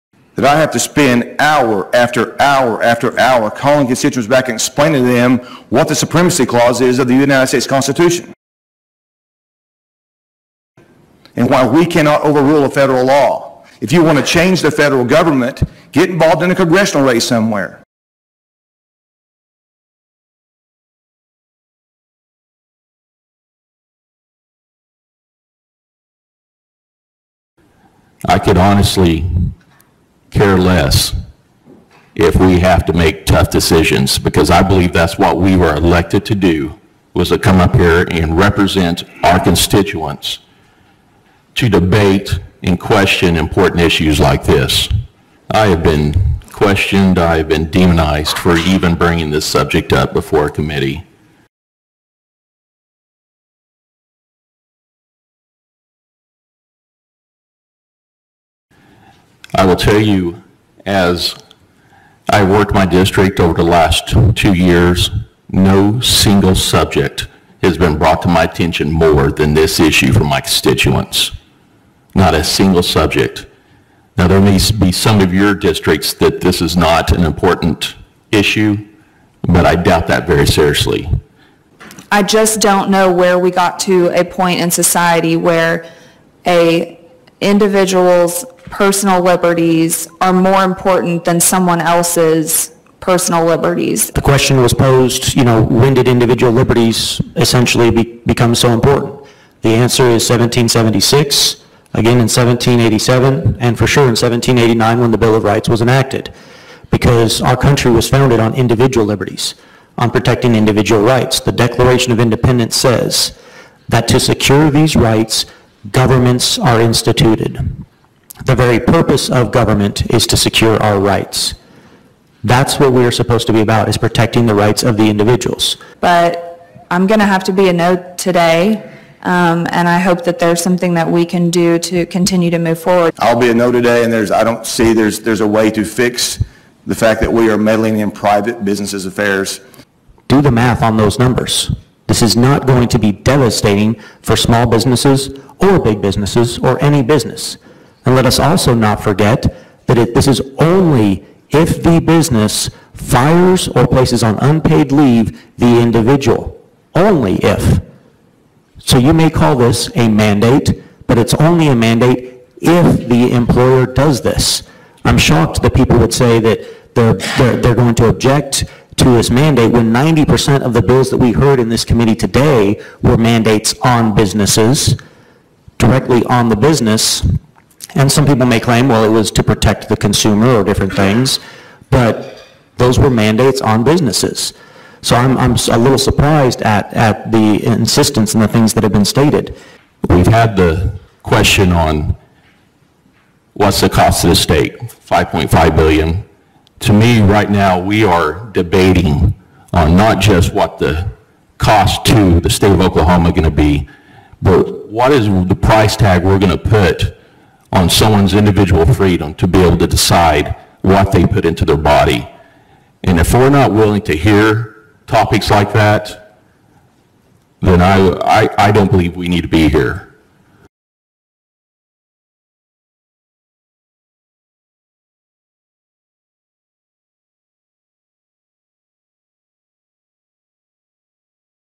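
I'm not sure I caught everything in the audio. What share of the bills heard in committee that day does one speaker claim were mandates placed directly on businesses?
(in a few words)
90%.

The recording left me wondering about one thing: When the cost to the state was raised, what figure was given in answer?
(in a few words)
5.5 billion.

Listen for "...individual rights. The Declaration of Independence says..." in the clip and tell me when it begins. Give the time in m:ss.
1:50.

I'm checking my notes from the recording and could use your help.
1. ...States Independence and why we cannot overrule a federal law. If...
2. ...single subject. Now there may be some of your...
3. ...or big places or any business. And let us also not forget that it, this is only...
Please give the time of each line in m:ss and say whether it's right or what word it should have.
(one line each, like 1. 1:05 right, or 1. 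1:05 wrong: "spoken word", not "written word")
1. 0:07 wrong: "Constitution", not "Independence"
2. 1:12 right
3. 2:25 wrong: "businesses", not "places".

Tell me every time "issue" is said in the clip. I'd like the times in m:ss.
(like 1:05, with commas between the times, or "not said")
0:43, 1:09, 1:18.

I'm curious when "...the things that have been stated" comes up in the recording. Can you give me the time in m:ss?
3:08.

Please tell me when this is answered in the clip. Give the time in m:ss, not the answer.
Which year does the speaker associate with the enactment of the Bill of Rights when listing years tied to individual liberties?
1:44.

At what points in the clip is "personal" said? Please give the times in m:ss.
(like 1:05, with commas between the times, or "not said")
1:28, 1:32.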